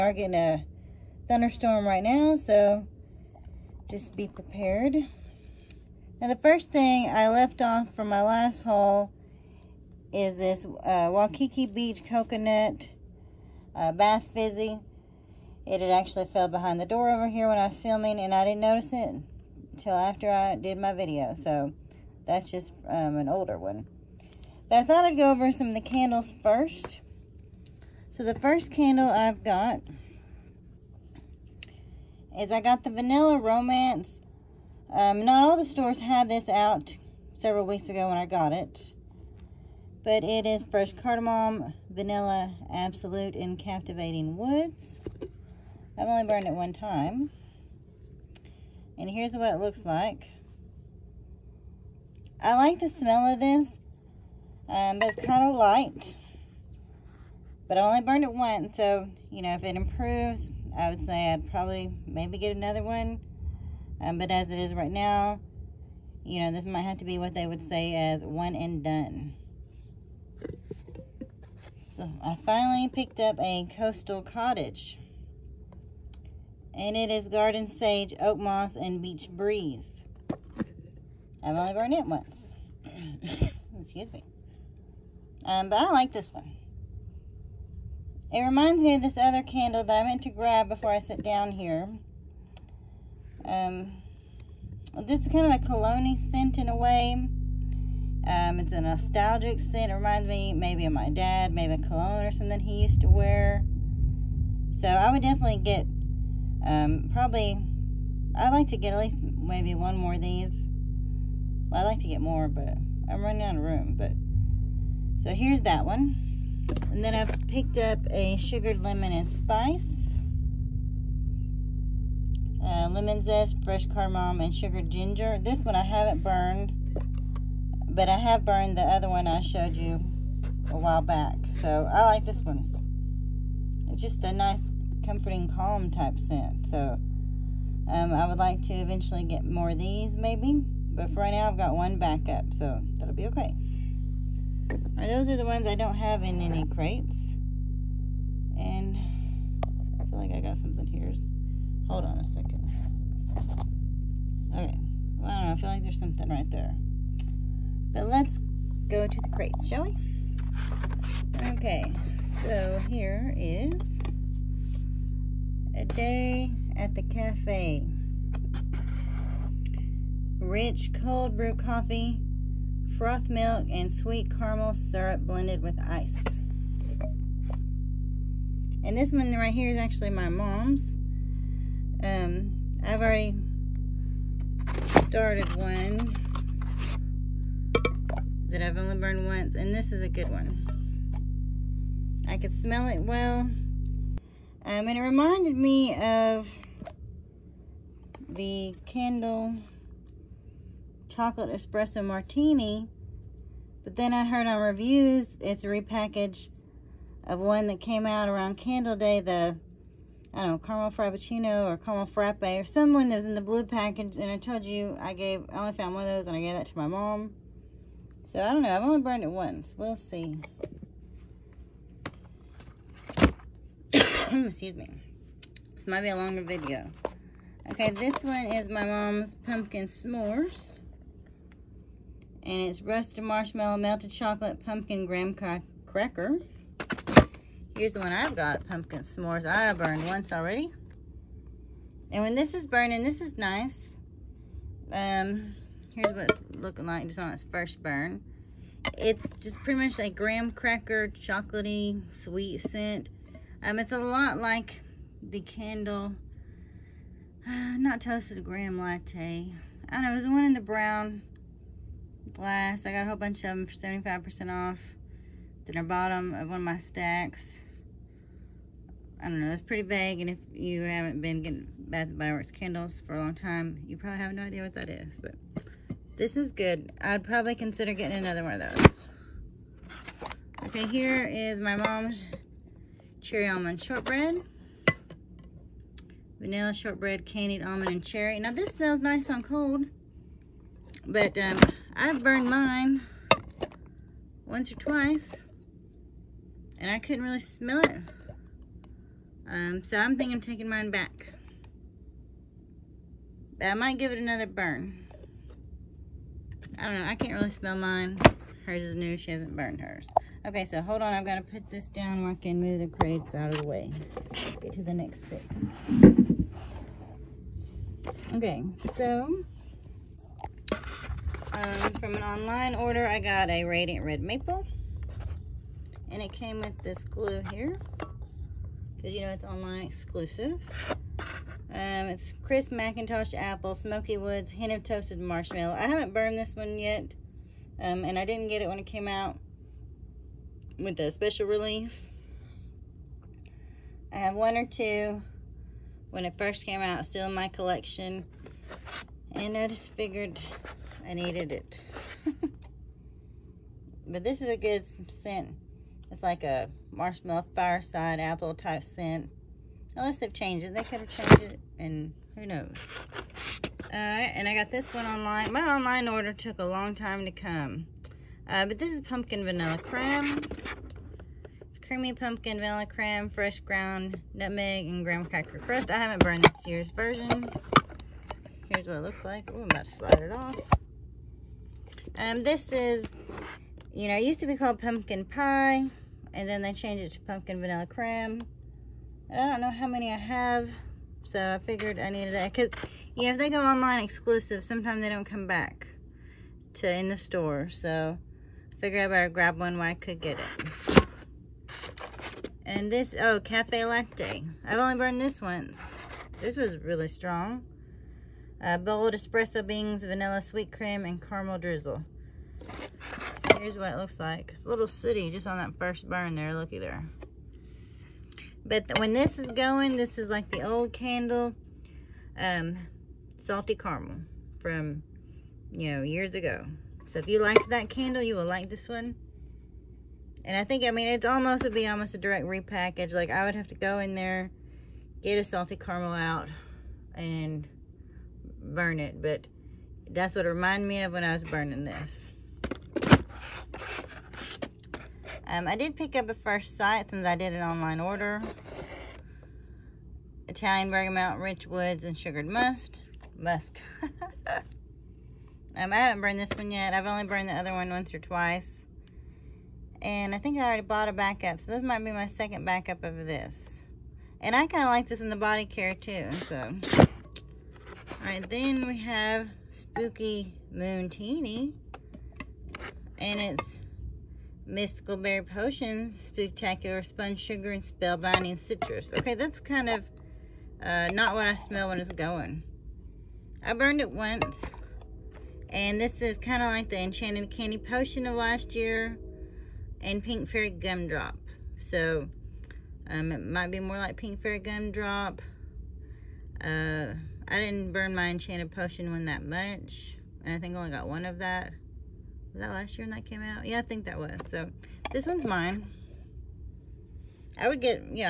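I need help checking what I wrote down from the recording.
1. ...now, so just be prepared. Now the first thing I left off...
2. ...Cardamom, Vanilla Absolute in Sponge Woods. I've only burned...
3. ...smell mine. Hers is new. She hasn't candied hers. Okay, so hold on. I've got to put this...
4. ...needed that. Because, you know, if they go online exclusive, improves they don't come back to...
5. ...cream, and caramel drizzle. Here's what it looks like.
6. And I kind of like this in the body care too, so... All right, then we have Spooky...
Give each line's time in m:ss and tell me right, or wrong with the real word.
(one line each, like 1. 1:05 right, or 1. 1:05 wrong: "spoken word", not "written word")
1. 0:02 right
2. 0:40 wrong: "Captivating", not "Sponge"
3. 5:07 wrong: "burned", not "candied"
4. 6:32 wrong: "sometimes", not "improves"
5. 6:50 right
6. 7:44 right.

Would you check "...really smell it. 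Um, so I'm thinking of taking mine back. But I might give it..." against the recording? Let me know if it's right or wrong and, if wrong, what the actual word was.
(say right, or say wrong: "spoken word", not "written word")
right.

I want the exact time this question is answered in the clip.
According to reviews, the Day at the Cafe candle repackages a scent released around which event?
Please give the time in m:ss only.
3:28.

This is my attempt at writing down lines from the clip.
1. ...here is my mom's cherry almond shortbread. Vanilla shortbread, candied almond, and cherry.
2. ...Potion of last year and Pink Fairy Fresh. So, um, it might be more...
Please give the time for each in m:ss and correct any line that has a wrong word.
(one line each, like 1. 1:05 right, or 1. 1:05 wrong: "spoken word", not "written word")
1. 4:40 right
2. 8:07 wrong: "Gumdrop", not "Fresh".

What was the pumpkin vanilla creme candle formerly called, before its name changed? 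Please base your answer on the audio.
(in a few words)
Pumpkin pie.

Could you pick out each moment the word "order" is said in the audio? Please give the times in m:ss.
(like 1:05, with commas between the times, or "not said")
5:22, 6:06, 7:27.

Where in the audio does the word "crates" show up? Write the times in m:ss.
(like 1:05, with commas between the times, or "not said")
2:26, 2:39, 5:12.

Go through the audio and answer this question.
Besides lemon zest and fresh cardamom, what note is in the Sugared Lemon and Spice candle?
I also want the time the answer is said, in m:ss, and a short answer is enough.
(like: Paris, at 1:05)
Sugared ginger, at 2:04.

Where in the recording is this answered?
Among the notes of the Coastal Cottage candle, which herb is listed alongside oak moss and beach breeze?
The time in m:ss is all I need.
1:17.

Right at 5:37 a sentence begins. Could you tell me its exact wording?
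Um, and I didn't get it when it came out with the special release.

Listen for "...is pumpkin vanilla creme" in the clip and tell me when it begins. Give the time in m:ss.
6:08.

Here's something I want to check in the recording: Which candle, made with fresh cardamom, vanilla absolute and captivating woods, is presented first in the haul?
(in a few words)
Vanilla Romance.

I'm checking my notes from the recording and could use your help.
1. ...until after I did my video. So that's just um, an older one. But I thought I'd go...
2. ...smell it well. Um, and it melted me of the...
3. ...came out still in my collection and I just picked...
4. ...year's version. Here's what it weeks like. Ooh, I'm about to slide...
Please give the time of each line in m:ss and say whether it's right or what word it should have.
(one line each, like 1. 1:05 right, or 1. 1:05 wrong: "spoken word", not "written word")
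1. 0:19 right
2. 3:12 wrong: "reminded", not "melted"
3. 5:46 wrong: "figured", not "picked"
4. 6:16 wrong: "looks", not "weeks".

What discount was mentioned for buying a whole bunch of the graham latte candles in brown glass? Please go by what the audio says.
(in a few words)
75% off.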